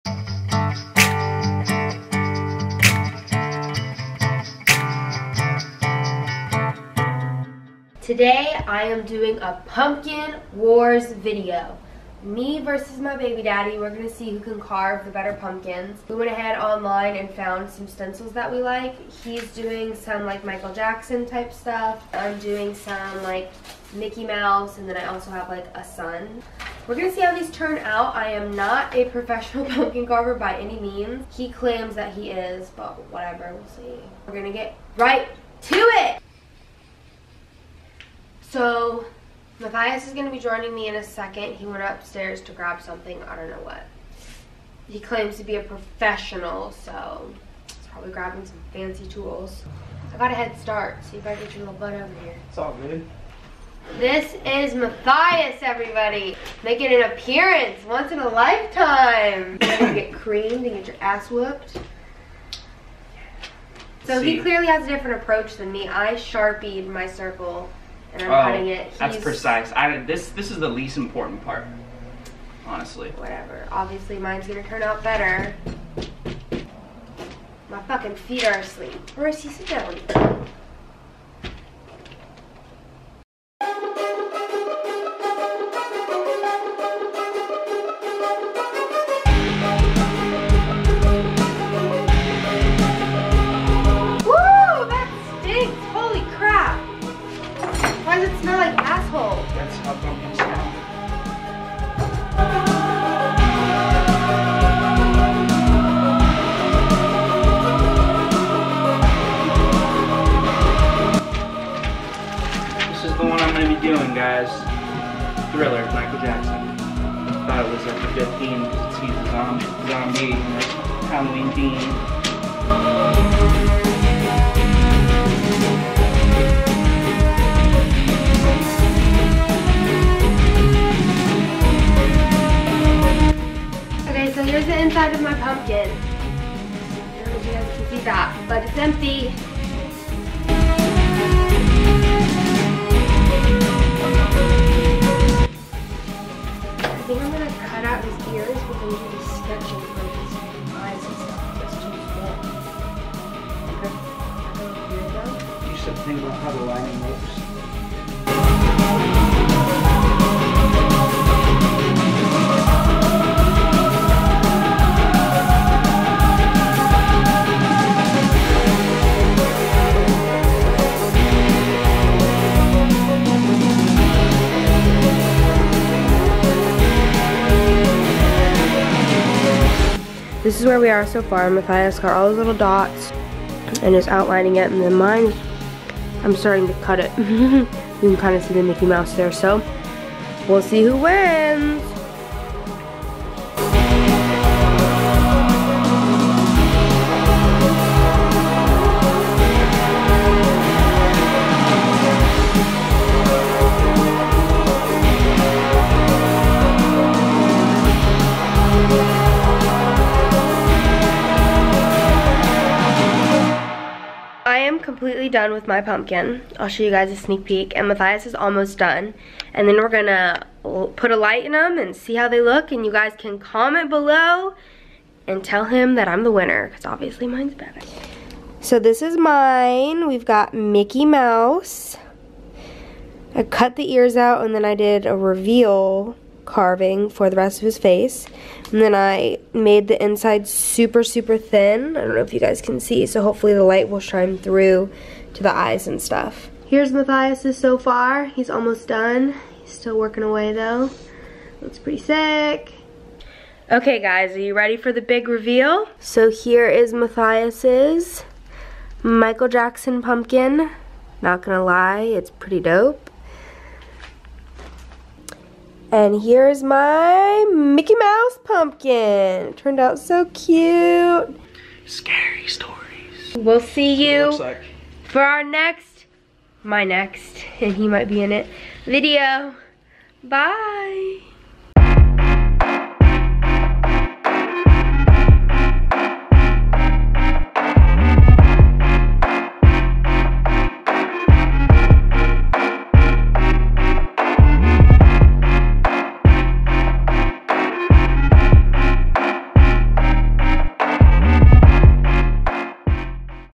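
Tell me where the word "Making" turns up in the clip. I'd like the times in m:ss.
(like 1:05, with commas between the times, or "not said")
0:56.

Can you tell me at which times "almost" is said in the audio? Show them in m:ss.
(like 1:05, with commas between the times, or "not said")
3:38, 4:08.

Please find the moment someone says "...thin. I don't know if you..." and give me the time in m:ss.
4:01.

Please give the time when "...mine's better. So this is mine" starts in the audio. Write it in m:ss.
3:47.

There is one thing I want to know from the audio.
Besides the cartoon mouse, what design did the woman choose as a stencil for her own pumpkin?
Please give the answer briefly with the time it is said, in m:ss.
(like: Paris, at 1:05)
a sun, at 0:25.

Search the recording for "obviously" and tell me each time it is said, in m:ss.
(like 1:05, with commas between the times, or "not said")
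1:13, 3:46.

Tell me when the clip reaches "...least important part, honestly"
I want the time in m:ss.
1:10.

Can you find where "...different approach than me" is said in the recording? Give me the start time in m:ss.
1:04.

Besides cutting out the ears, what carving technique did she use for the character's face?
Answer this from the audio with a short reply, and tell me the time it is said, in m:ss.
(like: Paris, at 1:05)
reveal carving, at 3:55.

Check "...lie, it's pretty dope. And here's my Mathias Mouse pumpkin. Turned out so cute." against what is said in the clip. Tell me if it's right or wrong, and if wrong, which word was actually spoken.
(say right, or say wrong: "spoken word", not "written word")
wrong: "Mickey", not "Mathias".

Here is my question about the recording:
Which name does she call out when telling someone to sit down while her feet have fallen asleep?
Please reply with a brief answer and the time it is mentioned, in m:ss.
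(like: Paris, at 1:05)
Royce, at 1:19.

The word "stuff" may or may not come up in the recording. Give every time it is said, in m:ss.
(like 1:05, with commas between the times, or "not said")
0:21, 4:06.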